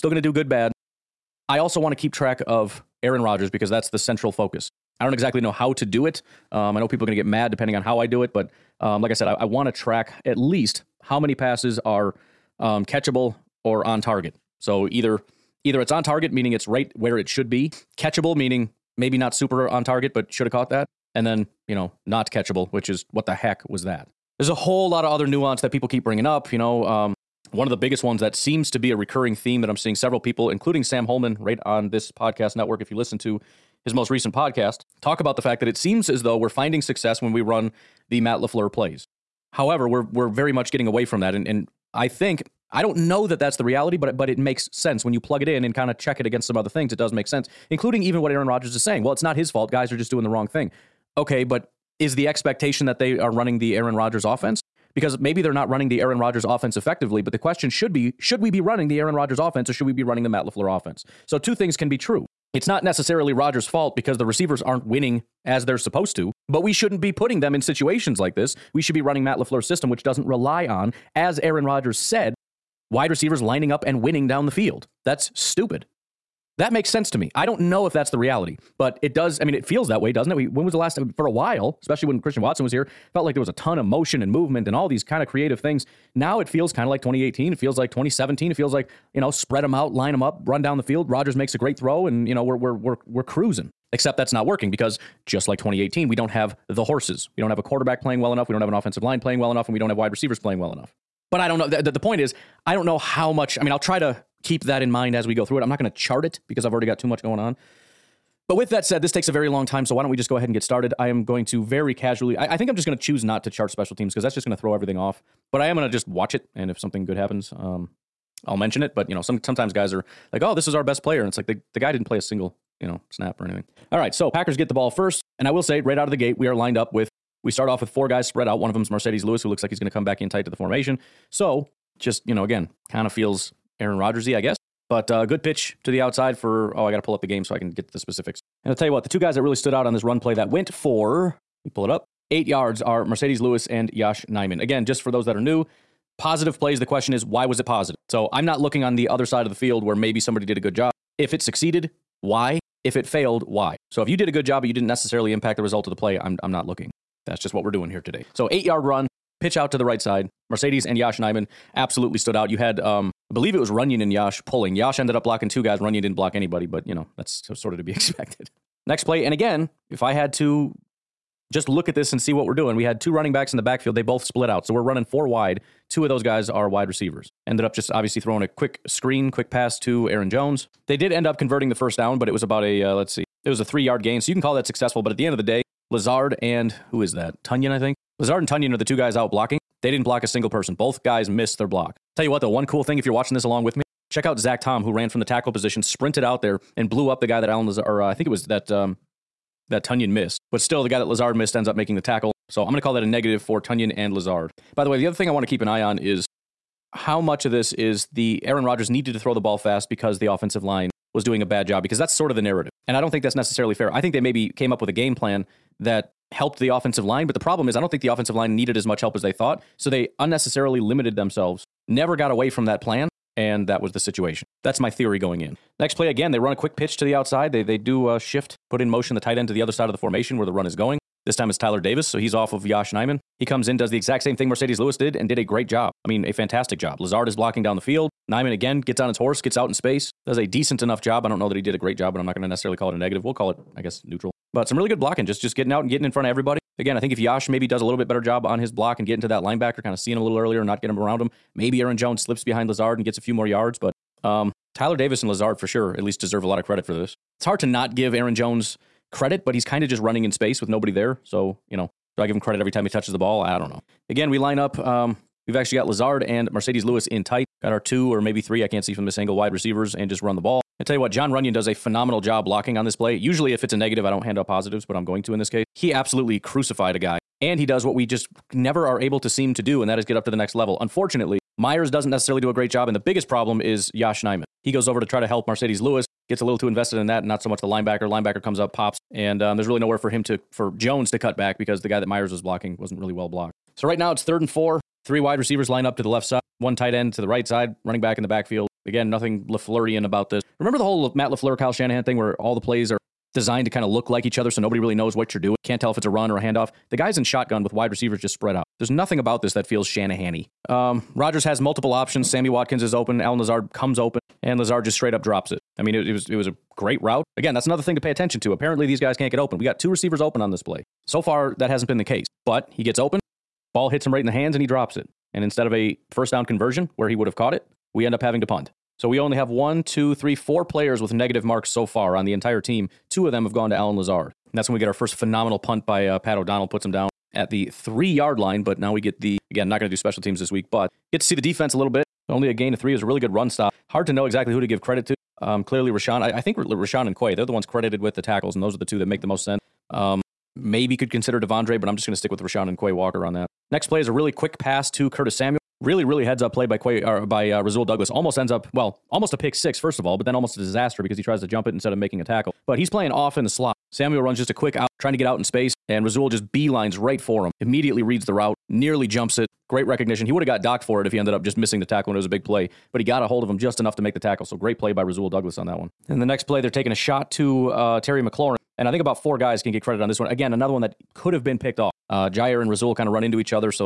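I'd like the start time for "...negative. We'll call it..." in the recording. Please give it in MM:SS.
04:02.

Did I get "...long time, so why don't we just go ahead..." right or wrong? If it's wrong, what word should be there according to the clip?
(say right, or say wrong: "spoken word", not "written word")
right.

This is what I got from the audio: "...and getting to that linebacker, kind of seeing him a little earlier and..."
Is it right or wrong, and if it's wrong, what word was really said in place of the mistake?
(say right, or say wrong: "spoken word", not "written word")
right.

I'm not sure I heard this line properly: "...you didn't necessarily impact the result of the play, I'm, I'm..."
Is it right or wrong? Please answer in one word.
right.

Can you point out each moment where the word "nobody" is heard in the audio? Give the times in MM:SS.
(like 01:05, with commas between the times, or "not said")
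04:20, 05:04.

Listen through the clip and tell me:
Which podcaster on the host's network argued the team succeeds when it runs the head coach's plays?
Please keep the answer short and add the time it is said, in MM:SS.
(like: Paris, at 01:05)
Sam Holman, at 00:30.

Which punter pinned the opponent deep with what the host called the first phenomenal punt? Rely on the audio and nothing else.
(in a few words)
Pat O'Donnell.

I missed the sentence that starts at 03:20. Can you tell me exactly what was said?
But still, the guy that Lazard missed ends up making the tackle.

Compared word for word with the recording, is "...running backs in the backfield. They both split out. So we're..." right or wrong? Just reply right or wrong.
right.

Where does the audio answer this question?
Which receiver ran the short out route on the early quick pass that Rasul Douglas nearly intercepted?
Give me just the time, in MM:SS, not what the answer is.
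05:55.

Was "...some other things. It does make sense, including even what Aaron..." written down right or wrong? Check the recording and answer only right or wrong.
right.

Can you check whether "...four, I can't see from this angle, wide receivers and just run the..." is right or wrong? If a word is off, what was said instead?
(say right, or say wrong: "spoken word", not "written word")
wrong: "three", not "four".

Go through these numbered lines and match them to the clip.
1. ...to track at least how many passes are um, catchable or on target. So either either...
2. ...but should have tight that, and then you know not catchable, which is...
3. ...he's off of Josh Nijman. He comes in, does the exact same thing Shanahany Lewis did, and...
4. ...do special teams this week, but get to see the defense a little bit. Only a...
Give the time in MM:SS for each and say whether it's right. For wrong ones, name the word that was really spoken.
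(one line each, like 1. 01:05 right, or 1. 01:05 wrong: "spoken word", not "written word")
1. 00:09 right
2. 00:20 wrong: "caught", not "tight"
3. 03:52 wrong: "Marcedes", not "Shanahany"
4. 05:39 right.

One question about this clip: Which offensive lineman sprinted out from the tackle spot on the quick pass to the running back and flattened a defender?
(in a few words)
Zach Tom.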